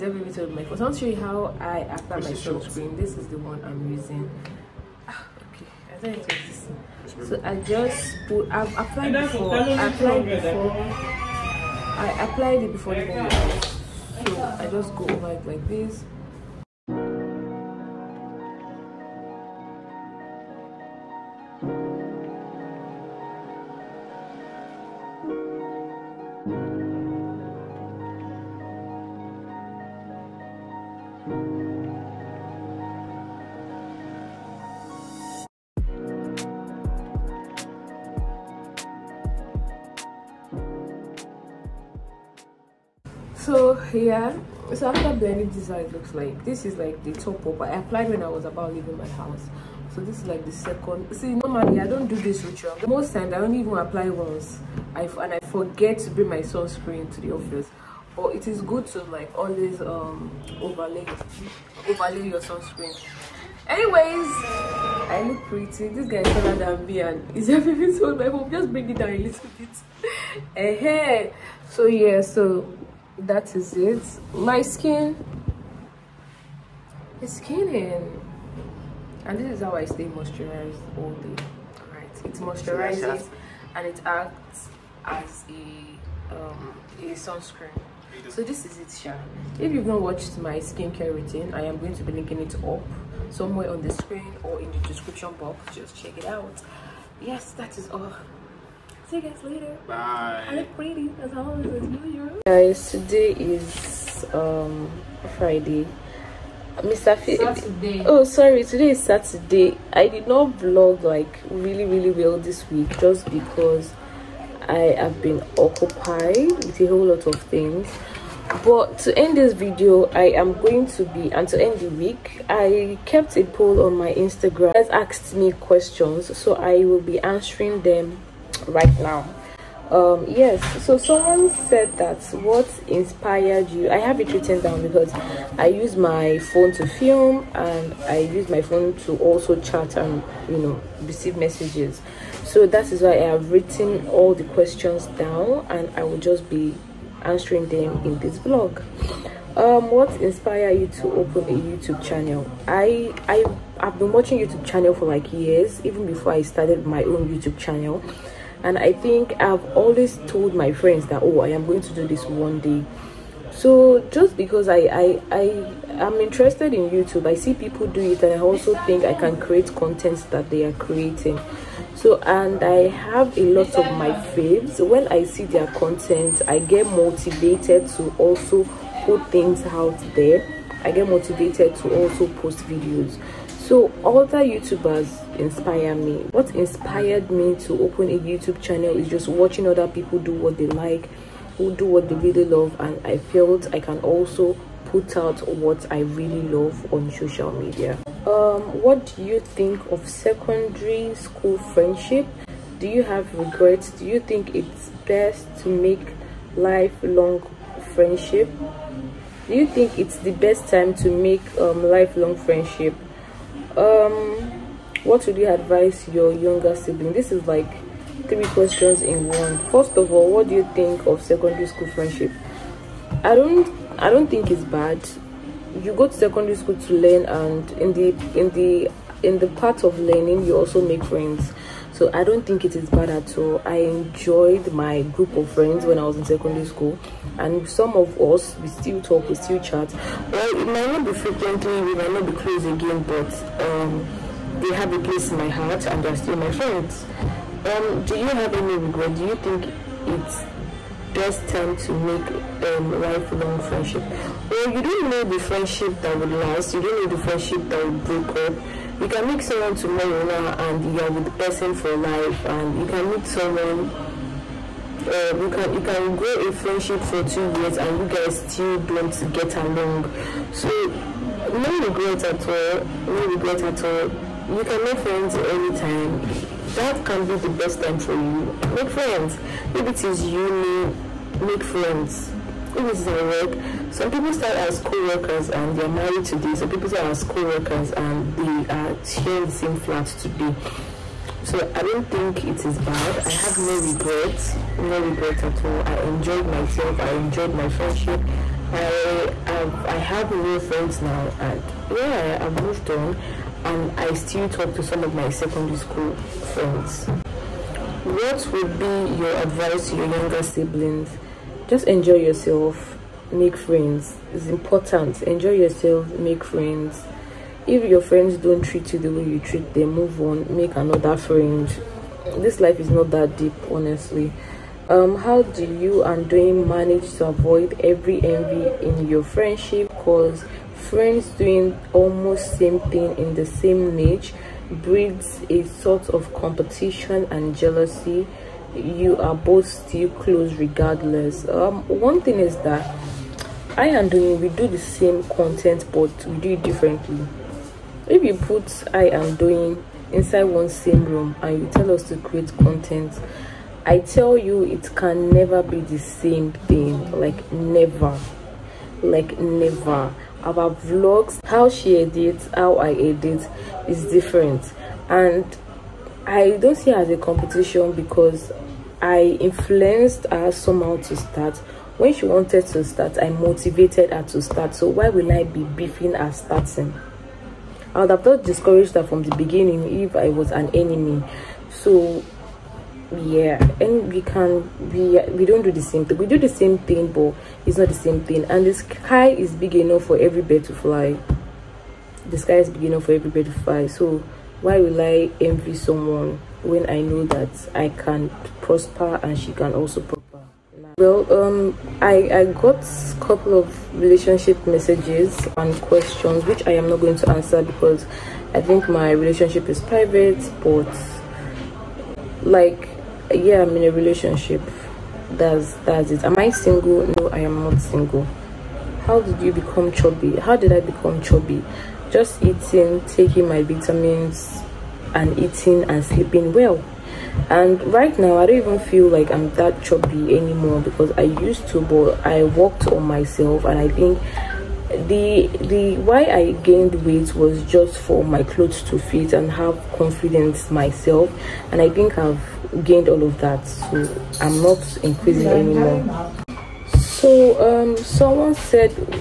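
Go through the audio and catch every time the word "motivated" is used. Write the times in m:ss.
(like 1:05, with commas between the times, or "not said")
2:56, 3:01, 6:13.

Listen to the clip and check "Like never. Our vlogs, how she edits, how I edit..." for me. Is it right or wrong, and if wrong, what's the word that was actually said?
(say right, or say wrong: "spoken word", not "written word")
right.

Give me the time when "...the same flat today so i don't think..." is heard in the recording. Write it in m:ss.
4:49.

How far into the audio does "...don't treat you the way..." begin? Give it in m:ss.
5:18.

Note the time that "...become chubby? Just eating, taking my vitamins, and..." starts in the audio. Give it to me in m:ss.
7:00.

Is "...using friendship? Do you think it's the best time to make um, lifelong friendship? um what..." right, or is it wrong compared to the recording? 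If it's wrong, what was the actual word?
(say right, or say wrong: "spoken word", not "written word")
wrong: "lifelong", not "using".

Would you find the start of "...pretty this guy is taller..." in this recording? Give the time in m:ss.
1:05.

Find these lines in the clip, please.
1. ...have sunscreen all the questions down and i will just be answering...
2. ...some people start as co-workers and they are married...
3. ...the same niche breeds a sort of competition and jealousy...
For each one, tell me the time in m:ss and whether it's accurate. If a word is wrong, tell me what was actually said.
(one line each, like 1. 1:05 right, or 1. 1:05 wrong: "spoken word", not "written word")
1. 2:23 wrong: "written", not "sunscreen"
2. 4:43 right
3. 5:33 right.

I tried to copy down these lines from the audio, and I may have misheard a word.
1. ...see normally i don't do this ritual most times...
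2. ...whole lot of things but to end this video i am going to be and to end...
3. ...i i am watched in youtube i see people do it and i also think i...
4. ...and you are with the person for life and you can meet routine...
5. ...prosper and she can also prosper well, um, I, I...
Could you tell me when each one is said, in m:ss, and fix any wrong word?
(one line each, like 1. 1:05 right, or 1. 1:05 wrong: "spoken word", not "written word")
1. 0:51 right
2. 1:56 right
3. 2:44 wrong: "interested", not "watched"
4. 4:20 wrong: "someone", not "routine"
5. 6:38 right.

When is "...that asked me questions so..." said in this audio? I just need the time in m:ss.
2:04.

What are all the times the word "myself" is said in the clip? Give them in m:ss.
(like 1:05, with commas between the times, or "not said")
4:56, 7:13, 7:20.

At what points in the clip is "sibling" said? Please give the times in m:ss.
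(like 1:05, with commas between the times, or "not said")
3:36, 5:10.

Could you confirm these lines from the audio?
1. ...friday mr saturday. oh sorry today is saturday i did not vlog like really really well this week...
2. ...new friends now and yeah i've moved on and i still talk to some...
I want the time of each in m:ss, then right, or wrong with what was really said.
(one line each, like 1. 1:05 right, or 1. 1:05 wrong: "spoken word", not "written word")
1. 1:45 right
2. 5:00 right.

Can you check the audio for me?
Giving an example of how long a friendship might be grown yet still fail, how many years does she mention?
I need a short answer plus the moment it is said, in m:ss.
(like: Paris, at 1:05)
2 years, at 4:27.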